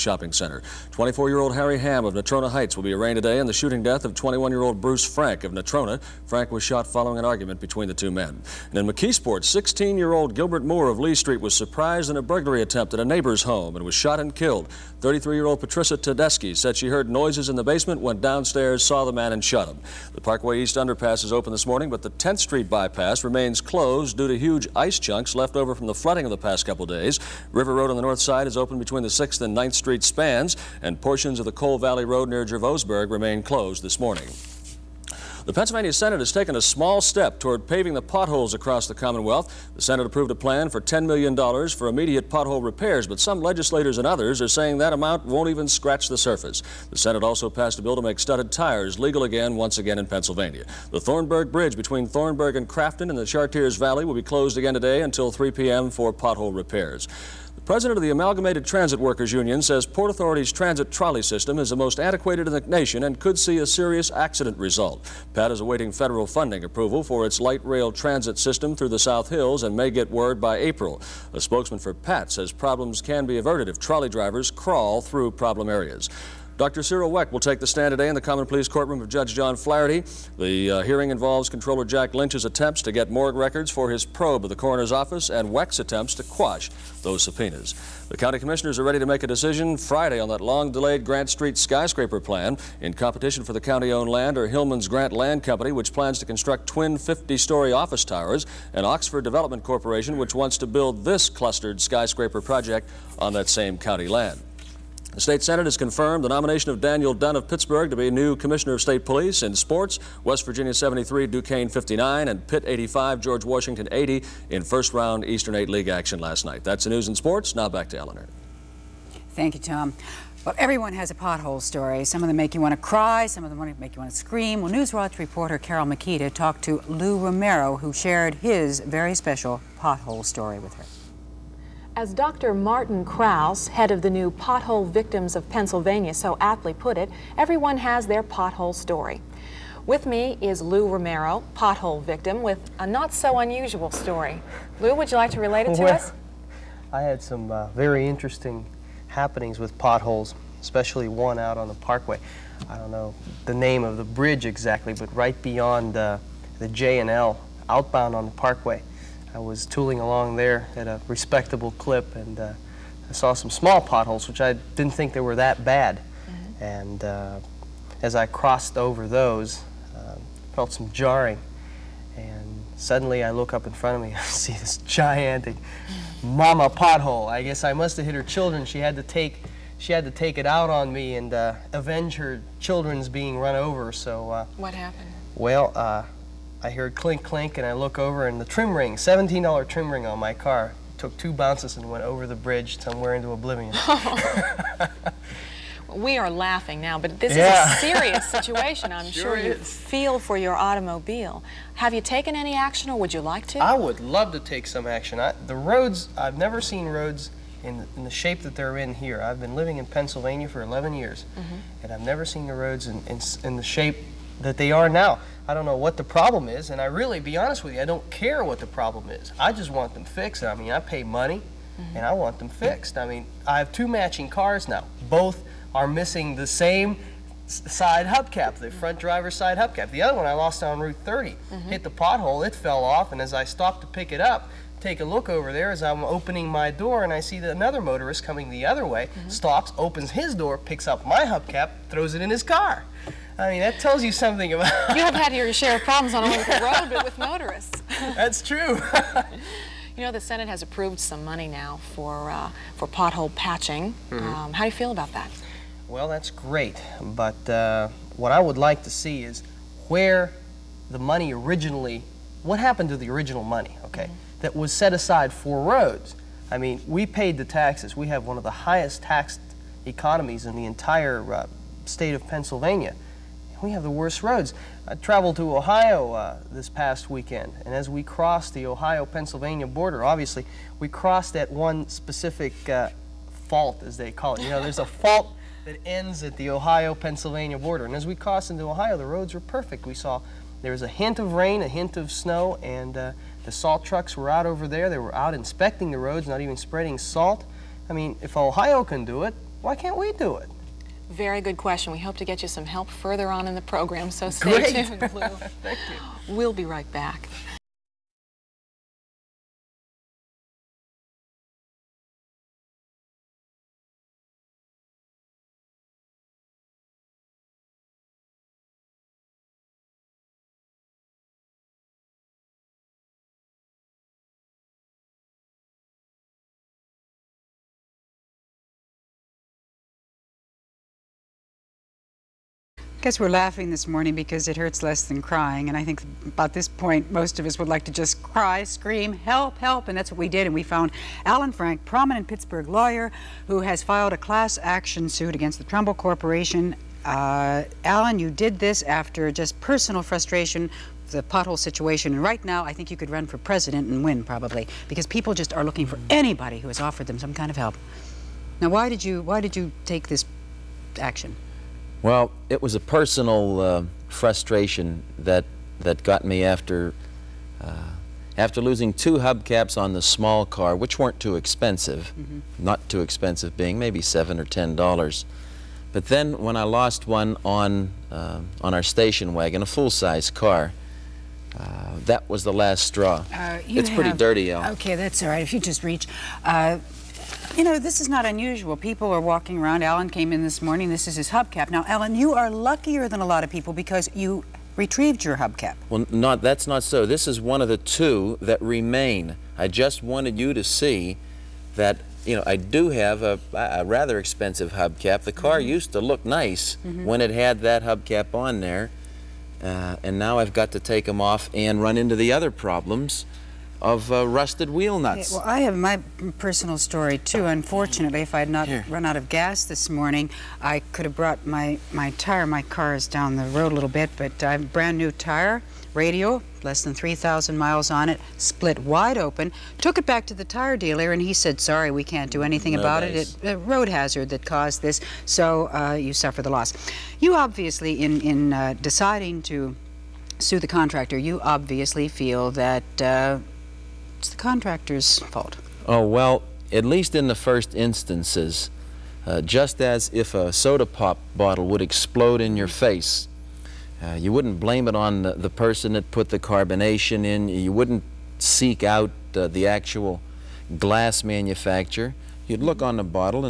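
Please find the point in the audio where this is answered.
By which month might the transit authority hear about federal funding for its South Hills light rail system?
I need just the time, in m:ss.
1:10.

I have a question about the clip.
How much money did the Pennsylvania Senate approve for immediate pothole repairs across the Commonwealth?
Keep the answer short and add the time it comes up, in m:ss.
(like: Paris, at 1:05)
$10 million, at 0:40.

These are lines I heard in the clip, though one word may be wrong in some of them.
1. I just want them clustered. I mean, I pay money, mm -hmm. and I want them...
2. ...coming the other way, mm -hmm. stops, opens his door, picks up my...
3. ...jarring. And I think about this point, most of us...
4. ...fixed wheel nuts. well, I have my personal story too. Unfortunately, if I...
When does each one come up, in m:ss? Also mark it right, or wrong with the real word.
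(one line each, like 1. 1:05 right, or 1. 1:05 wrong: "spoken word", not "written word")
1. 3:39 wrong: "fixed", not "clustered"
2. 3:58 right
3. 5:35 wrong: "crying", not "jarring"
4. 6:54 wrong: "rusted", not "fixed".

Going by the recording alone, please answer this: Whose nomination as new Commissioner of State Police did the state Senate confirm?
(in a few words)
Daniel Dunn.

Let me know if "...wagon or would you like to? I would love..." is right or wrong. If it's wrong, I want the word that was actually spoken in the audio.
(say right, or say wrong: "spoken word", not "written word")
wrong: "action", not "wagon".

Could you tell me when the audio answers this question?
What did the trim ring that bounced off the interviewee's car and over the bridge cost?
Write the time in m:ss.
3:08.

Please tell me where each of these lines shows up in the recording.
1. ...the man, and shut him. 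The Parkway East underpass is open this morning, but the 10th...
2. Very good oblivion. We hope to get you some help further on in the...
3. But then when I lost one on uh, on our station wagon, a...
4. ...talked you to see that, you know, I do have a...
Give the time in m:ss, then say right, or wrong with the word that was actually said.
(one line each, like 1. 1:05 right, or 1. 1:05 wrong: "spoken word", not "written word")
1. 0:19 right
2. 5:01 wrong: "question", not "oblivion"
3. 6:15 right
4. 6:40 wrong: "wanted", not "talked".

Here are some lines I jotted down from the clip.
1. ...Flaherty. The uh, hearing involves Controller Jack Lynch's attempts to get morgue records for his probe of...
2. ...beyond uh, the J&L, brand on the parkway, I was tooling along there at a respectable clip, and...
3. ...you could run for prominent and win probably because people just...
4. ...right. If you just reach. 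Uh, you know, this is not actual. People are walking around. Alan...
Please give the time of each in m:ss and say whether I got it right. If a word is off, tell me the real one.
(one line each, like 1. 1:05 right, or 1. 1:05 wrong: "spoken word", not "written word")
1. 1:19 right
2. 2:35 wrong: "outbound", not "brand"
3. 5:52 wrong: "president", not "prominent"
4. 6:25 wrong: "unusual", not "actual".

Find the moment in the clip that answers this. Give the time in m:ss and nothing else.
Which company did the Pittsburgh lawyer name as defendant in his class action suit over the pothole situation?
5:45.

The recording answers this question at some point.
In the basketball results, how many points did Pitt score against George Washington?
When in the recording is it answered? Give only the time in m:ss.
1:52.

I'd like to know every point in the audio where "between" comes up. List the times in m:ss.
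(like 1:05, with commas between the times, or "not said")
0:07, 0:28, 0:51.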